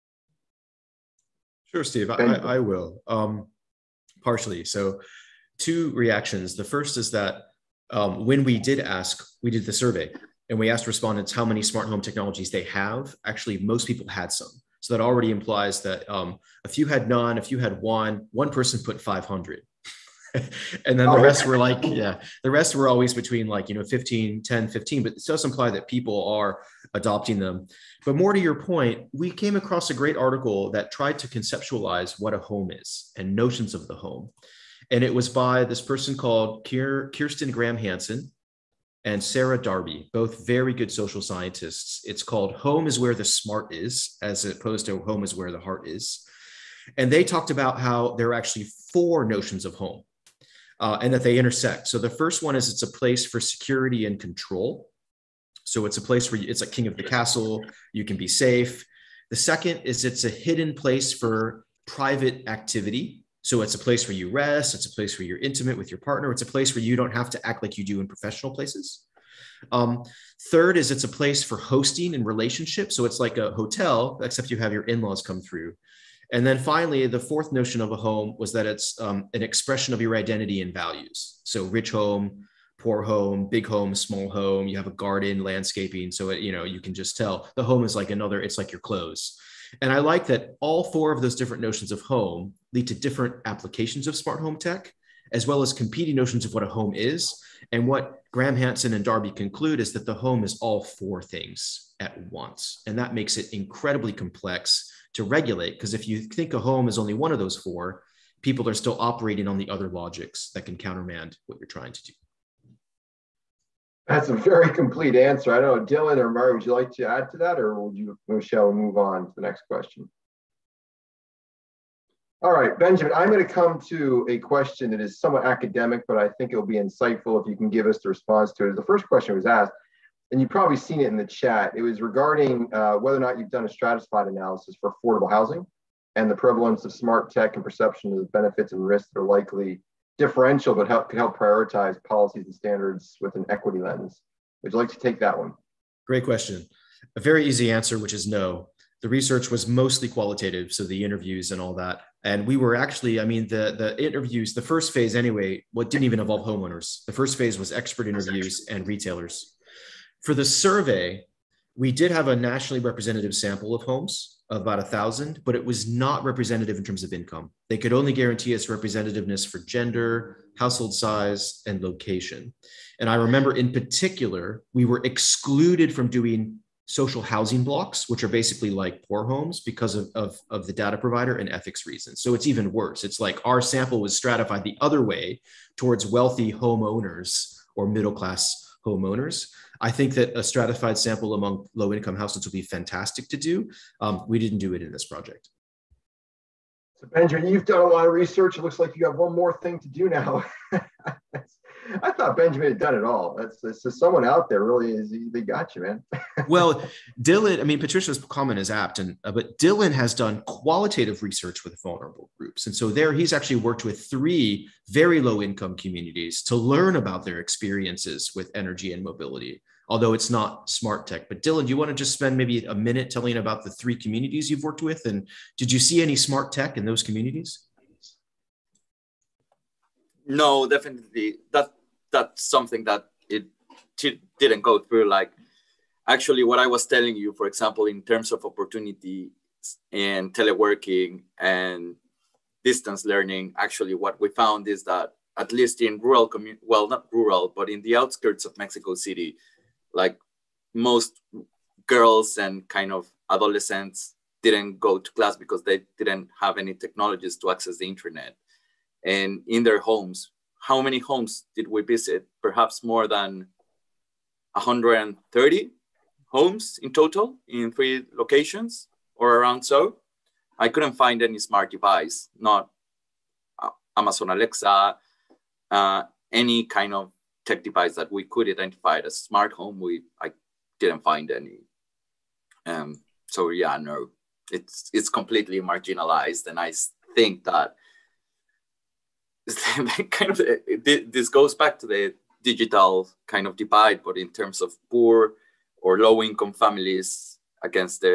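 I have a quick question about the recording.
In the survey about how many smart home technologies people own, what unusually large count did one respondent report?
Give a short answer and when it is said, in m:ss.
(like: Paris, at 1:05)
500, at 0:19.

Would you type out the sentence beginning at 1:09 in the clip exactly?
Um, third is it's a place for hosting and relationships.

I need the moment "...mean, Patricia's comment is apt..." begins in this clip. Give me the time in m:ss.
3:27.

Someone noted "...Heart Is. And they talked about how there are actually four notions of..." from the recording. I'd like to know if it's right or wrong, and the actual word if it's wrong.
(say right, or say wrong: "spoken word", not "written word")
right.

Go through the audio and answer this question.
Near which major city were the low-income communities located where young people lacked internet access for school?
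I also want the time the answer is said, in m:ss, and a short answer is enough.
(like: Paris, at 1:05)
Mexico City, at 4:08.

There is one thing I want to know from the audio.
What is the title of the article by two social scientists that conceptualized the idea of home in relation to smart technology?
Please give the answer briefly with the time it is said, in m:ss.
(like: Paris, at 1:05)
Home is Where the Smart Is, at 0:42.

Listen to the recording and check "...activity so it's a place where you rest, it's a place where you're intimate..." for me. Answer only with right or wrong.
right.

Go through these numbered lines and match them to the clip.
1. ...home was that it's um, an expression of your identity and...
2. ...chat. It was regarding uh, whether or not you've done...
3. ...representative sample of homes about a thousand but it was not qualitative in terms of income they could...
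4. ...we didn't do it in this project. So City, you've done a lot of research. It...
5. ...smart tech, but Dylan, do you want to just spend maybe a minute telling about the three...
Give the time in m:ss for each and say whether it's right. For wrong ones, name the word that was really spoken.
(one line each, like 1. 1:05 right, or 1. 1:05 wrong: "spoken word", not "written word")
1. 1:17 right
2. 2:11 right
3. 2:42 wrong: "representative", not "qualitative"
4. 3:14 wrong: "Benjamin", not "City"
5. 3:40 right.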